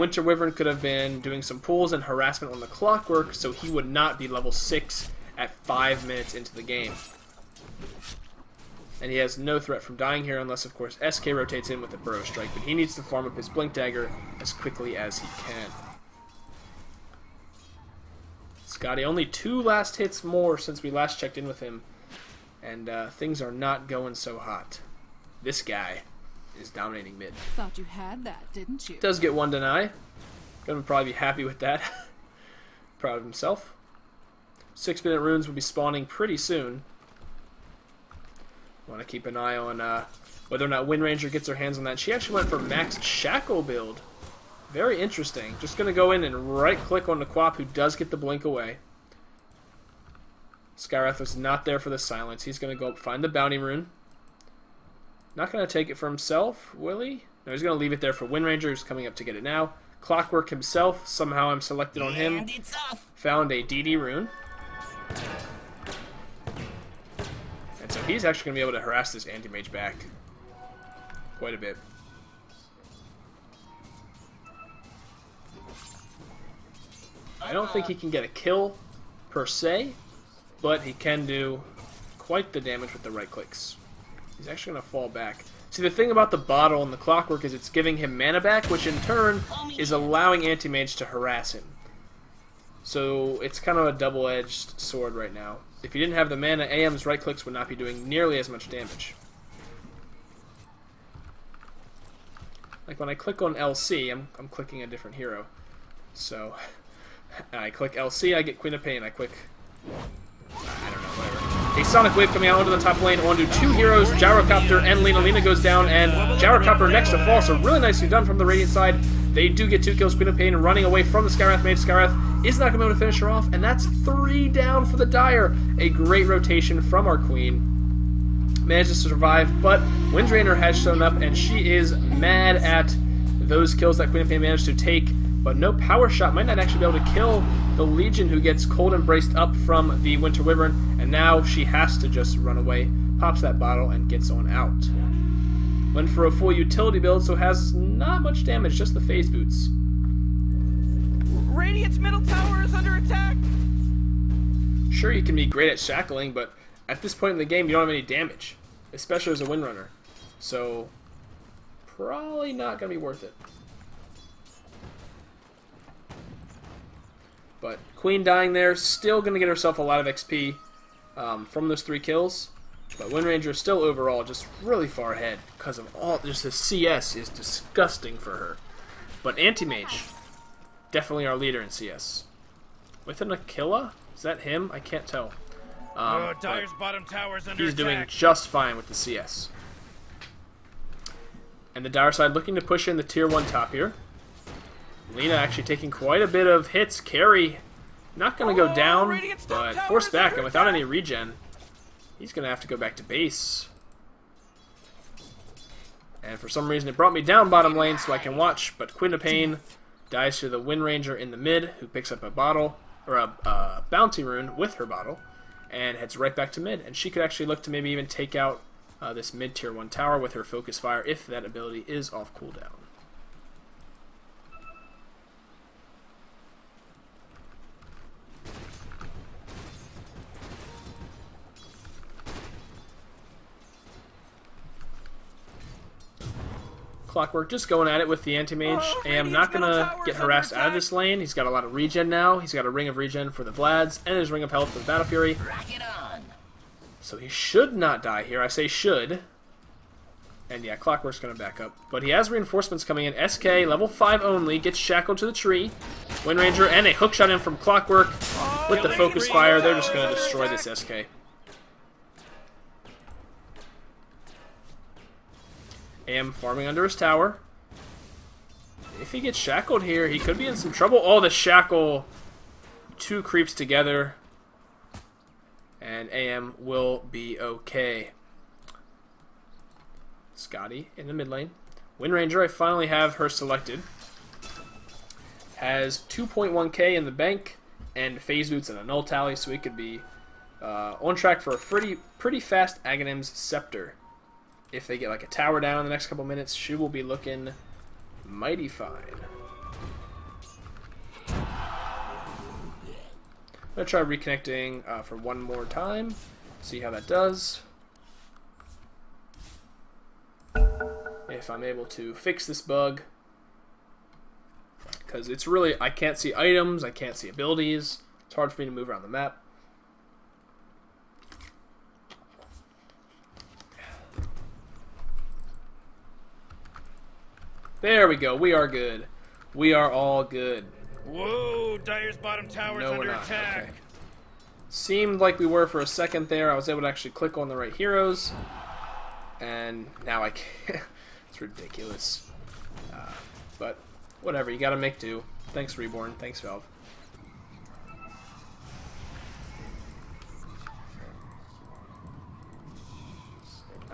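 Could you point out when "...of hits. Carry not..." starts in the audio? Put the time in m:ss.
3:16.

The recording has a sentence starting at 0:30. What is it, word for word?
Gonna probably be happy with that.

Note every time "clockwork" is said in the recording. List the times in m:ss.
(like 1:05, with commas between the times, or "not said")
0:02, 1:00, 1:26, 3:57, 4:10, 4:17.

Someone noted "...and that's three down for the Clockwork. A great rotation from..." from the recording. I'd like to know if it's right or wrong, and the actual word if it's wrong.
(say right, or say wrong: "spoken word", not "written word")
wrong: "Dire", not "Clockwork".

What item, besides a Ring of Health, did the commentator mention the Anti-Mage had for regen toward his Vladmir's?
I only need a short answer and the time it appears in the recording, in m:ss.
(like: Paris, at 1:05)
Ring of Regen, at 4:02.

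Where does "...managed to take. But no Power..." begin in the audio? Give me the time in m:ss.
2:14.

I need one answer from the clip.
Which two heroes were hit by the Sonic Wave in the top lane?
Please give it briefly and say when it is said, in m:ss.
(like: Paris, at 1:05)
Gyrocopter and Lina, at 1:54.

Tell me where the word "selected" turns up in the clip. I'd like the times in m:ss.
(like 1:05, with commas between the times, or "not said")
1:01, 4:43.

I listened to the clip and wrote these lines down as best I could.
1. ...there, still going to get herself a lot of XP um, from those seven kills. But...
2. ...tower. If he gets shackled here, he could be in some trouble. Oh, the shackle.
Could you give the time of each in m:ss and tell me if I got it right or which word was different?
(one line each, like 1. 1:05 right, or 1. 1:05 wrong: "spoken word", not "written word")
1. 2:48 wrong: "three", not "seven"
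2. 4:26 right.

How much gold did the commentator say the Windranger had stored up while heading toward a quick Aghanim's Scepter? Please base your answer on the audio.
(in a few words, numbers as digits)
2.1k.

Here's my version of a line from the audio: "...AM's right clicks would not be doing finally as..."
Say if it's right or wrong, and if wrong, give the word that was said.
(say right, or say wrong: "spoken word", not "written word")
wrong: "nearly", not "finally".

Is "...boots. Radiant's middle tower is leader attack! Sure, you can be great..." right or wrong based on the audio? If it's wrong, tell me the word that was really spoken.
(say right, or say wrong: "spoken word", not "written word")
wrong: "under", not "leader".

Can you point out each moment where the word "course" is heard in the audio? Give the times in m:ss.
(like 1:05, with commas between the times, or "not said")
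0:10.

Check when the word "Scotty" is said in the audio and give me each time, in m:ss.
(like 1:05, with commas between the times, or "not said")
0:18, 4:40.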